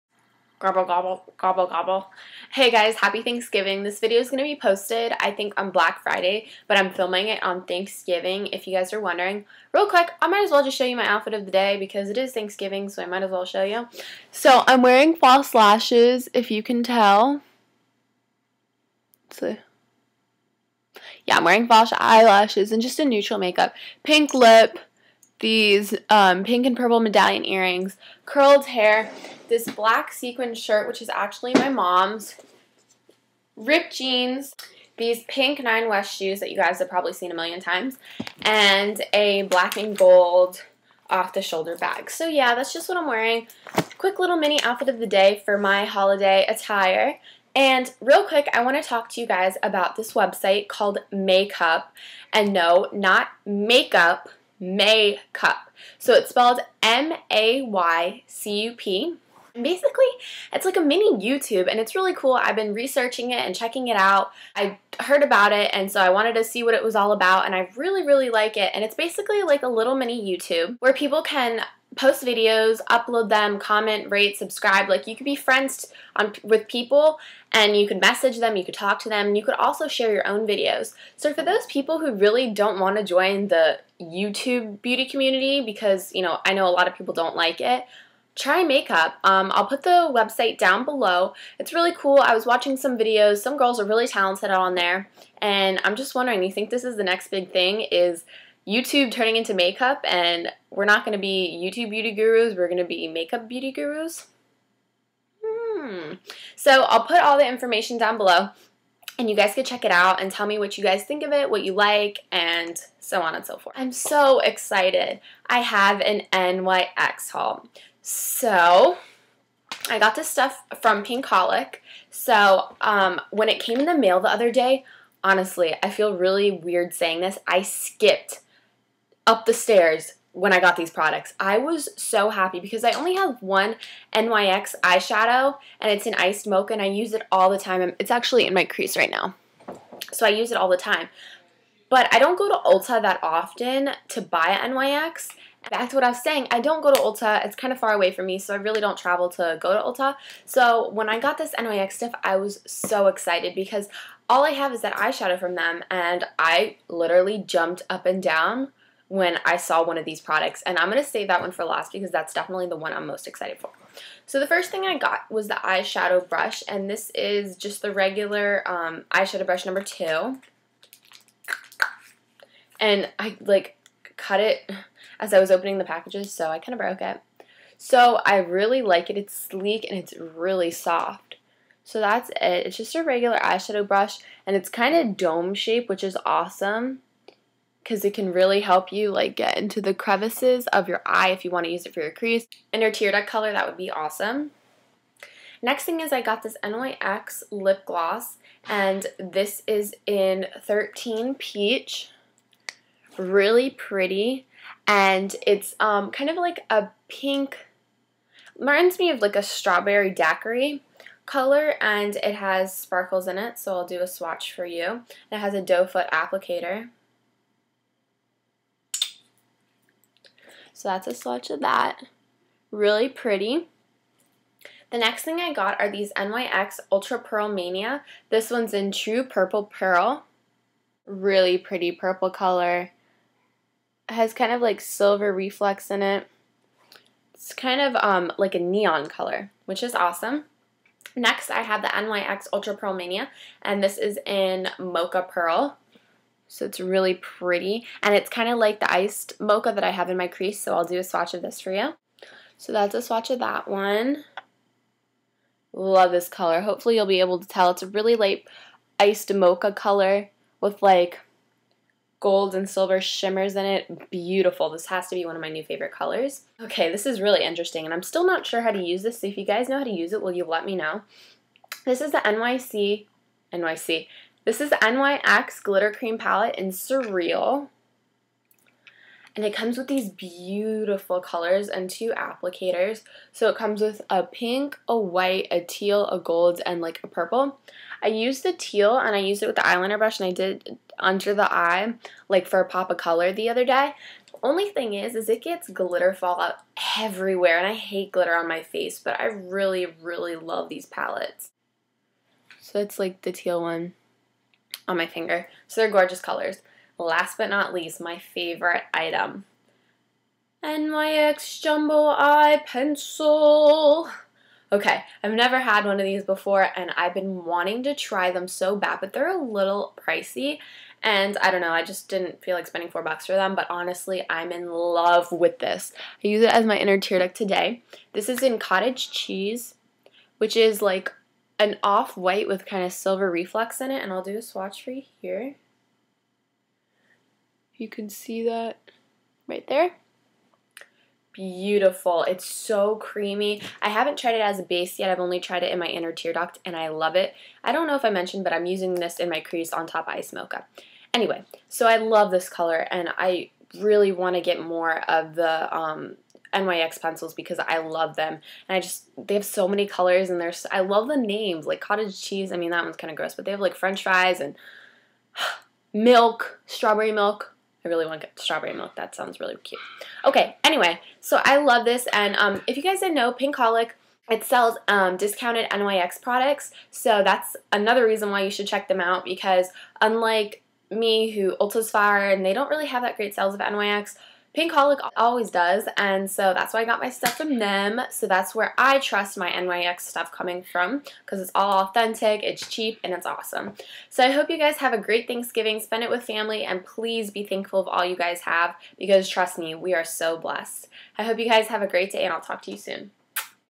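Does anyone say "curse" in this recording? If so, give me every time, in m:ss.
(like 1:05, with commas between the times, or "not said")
not said.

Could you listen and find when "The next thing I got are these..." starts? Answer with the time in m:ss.
3:44.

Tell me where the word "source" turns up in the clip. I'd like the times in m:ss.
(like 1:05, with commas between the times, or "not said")
not said.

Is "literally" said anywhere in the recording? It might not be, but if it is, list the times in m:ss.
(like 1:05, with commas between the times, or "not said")
2:36.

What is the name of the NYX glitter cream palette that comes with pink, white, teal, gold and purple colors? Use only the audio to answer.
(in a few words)
Surreal.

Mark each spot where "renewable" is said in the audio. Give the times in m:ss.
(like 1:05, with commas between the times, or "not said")
not said.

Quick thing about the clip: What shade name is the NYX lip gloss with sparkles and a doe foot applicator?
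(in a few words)
13 Peach.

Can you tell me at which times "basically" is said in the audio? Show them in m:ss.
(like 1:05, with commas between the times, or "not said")
0:59, 1:08.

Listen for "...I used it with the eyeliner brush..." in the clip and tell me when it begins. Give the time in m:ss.
4:49.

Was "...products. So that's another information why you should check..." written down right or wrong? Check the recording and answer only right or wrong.
wrong.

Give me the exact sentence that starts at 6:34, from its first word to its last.
So I hope you guys have a great Thanksgiving.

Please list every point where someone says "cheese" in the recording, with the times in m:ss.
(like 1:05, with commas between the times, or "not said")
5:29, 6:02.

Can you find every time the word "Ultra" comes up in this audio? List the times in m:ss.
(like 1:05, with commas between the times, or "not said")
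3:46, 4:02.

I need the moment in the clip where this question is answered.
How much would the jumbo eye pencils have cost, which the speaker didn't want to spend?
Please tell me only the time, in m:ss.
5:22.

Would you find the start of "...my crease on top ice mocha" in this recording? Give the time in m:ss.
5:49.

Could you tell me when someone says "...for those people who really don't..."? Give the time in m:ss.
1:21.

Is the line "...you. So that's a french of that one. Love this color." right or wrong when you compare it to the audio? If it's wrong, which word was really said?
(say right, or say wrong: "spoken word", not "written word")
wrong: "swatch", not "french".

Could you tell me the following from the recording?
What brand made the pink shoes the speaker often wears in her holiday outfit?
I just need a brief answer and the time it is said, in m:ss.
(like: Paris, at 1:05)
Nine West, at 0:35.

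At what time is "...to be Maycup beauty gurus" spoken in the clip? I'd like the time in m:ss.
1:42.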